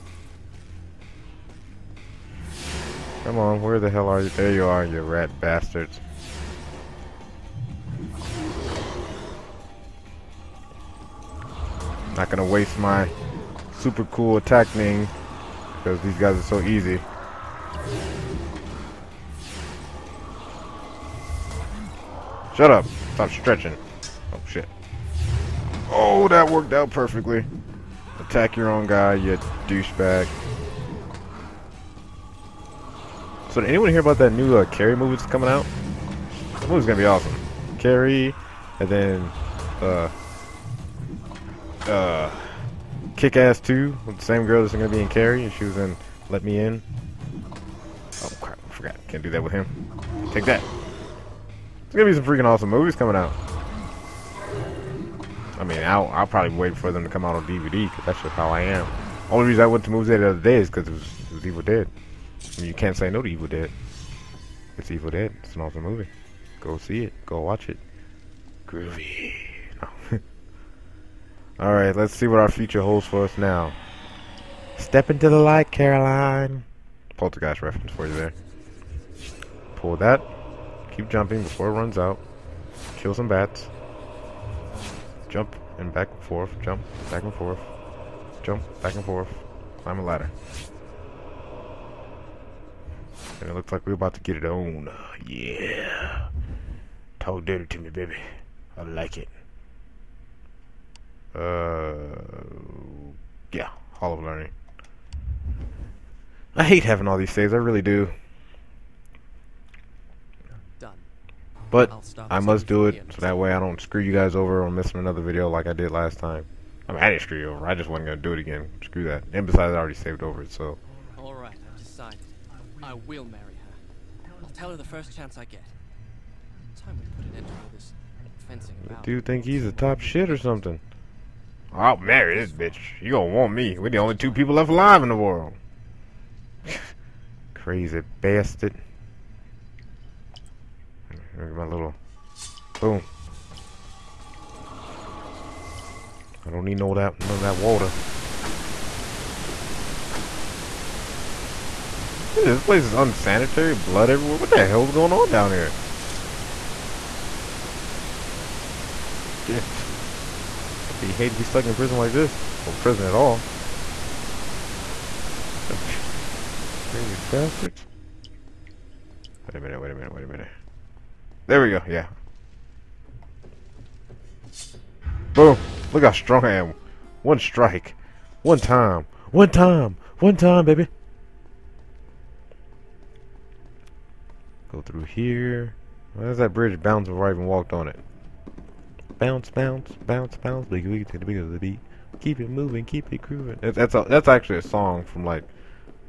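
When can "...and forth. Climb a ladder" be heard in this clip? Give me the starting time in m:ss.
1:28.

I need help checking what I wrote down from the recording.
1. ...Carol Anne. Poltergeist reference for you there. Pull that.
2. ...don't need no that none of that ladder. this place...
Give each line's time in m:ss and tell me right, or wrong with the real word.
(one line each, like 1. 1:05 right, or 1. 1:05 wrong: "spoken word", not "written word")
1. 1:15 right
2. 2:26 wrong: "water", not "ladder".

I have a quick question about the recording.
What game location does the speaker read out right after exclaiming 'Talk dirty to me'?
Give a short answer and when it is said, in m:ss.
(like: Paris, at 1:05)
Hall of Learning, at 1:43.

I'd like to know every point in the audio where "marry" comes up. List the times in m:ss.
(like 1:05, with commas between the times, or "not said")
2:03, 2:11.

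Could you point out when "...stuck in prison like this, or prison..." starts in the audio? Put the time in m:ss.
2:41.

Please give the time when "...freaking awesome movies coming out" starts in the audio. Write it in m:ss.
0:52.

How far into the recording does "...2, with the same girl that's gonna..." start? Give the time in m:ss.
0:43.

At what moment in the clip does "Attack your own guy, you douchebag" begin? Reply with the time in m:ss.
0:28.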